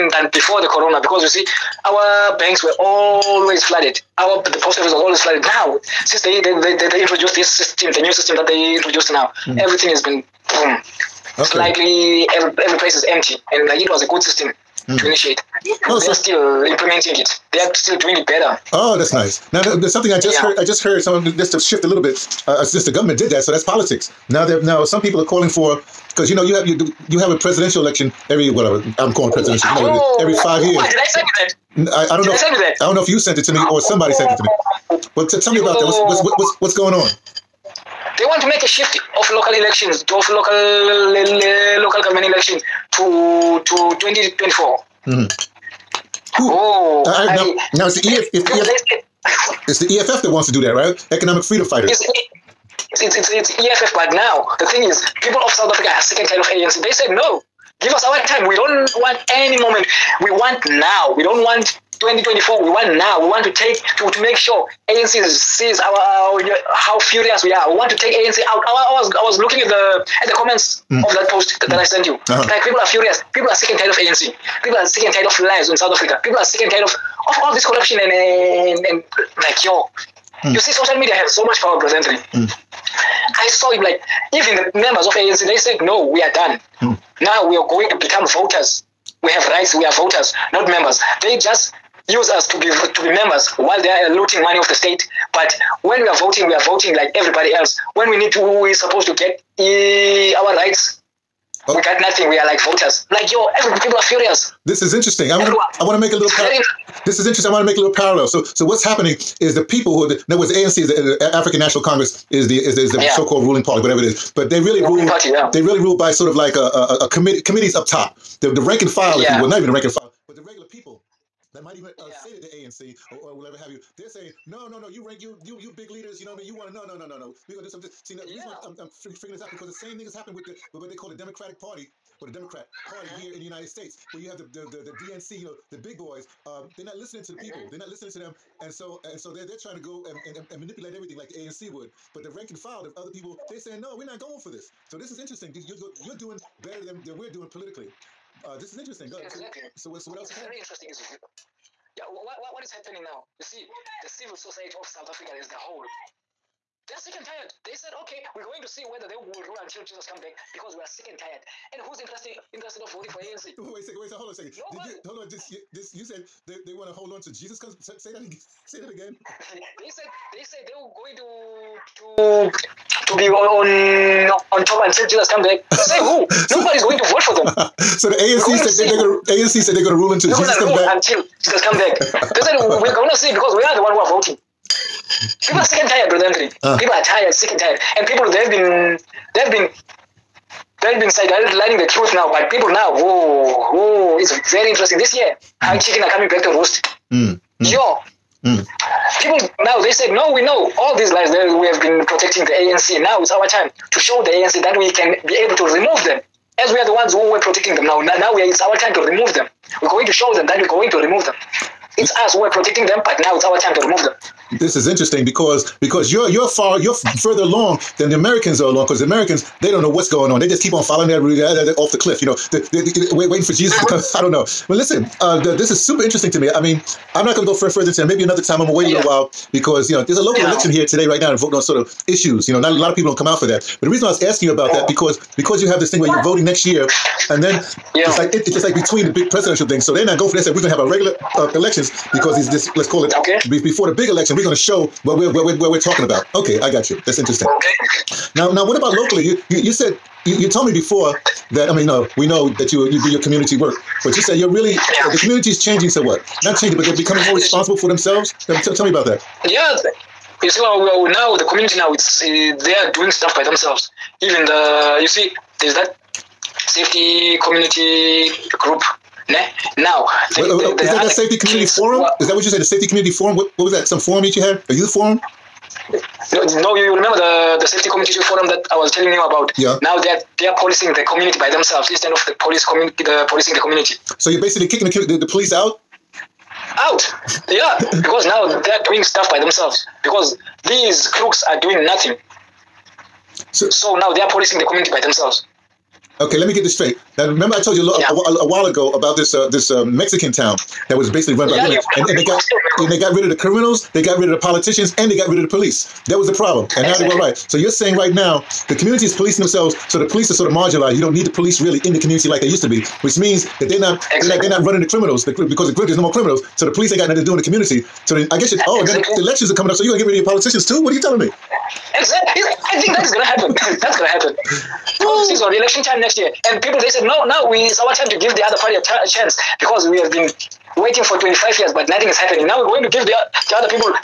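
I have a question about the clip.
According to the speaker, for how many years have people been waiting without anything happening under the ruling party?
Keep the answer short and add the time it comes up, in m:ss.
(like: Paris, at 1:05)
25, at 5:31.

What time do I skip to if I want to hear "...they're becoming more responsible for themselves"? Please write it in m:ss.
4:16.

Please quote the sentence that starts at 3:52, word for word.
You know, not a lot of people don't come out for that.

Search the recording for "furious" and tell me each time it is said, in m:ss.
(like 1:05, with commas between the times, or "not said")
1:06, 1:12, 1:44.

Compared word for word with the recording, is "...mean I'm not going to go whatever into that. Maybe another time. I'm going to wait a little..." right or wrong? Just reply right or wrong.
wrong.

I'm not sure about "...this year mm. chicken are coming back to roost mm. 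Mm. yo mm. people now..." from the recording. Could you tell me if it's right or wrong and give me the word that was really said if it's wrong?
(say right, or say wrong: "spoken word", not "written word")
right.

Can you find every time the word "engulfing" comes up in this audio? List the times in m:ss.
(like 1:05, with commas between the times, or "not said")
not said.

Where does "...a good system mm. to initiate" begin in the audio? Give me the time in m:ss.
0:14.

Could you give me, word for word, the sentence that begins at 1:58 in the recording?
The, the rank and file, yeah.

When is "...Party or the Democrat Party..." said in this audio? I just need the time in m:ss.
2:11.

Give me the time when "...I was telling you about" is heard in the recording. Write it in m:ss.
4:38.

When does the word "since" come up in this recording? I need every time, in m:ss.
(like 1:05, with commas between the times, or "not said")
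0:06, 0:22.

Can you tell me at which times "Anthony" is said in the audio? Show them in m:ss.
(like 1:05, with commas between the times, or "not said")
1:21, 3:06.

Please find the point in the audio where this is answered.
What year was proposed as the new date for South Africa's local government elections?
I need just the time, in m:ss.
0:40.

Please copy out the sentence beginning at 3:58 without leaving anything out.
It's like it, it's like between the big presidential things.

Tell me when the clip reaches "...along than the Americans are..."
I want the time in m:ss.
3:37.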